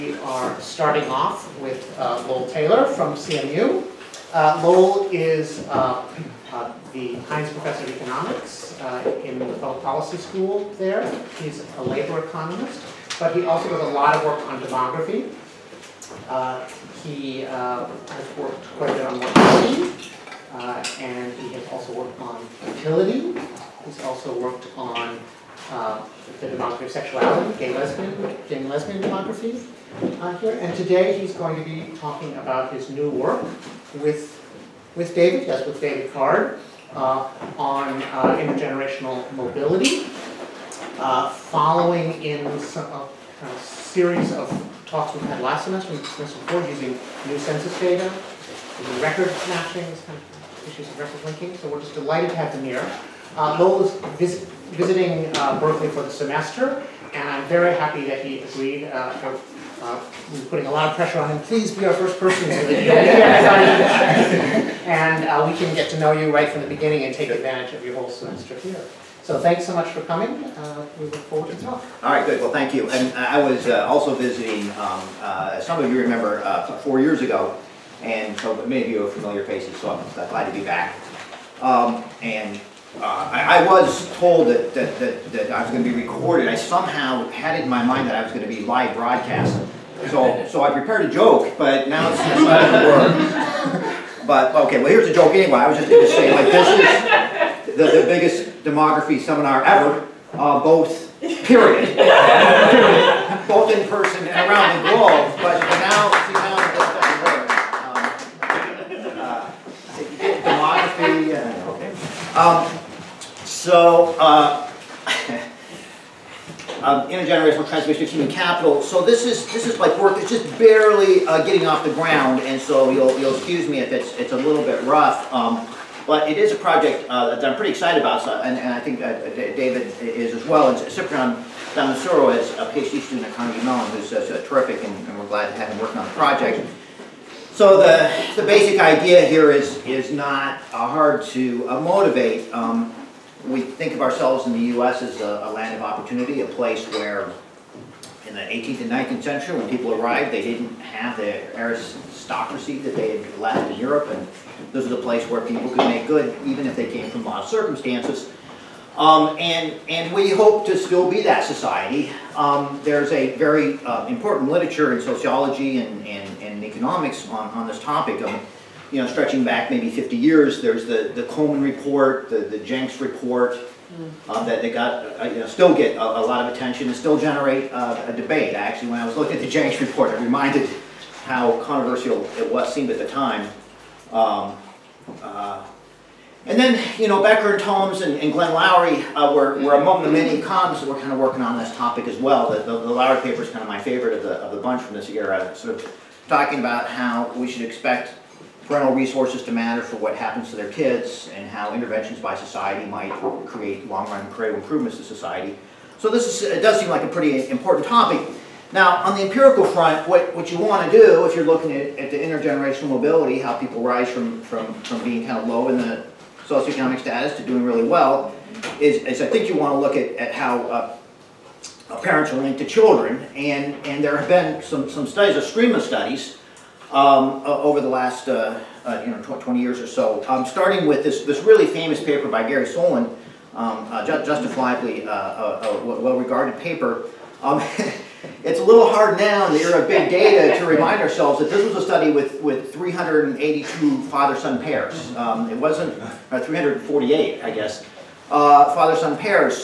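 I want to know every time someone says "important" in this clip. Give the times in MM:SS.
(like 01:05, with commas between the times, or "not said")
02:44, 03:27.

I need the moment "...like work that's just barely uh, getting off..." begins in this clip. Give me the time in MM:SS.
01:59.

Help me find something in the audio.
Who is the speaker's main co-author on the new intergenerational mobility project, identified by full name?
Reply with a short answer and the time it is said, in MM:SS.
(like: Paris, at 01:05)
David Card, at 00:35.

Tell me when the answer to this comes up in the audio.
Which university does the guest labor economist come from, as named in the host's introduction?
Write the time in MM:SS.
00:03.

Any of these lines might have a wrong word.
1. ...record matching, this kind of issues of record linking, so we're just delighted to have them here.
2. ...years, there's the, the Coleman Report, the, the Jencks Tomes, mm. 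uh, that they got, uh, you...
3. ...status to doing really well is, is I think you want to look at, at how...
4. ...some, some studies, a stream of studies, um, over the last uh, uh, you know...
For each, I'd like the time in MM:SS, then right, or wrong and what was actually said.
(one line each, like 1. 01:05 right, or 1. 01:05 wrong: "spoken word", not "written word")
1. 00:49 right
2. 02:50 wrong: "Report", not "Tomes"
3. 03:36 right
4. 03:44 right.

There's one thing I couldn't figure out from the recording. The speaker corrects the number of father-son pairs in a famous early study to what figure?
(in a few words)
348.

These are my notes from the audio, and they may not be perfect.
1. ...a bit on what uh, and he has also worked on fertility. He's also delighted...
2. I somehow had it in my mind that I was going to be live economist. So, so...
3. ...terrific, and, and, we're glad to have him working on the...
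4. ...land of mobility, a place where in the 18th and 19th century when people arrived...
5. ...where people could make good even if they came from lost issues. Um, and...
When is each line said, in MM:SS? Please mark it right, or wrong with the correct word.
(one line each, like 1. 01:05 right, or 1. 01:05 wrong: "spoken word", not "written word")
1. 00:18 wrong: "worked", not "delighted"
2. 01:26 wrong: "broadcast", not "economist"
3. 02:14 right
4. 02:25 wrong: "opportunity", not "mobility"
5. 02:35 wrong: "circumstances", not "issues".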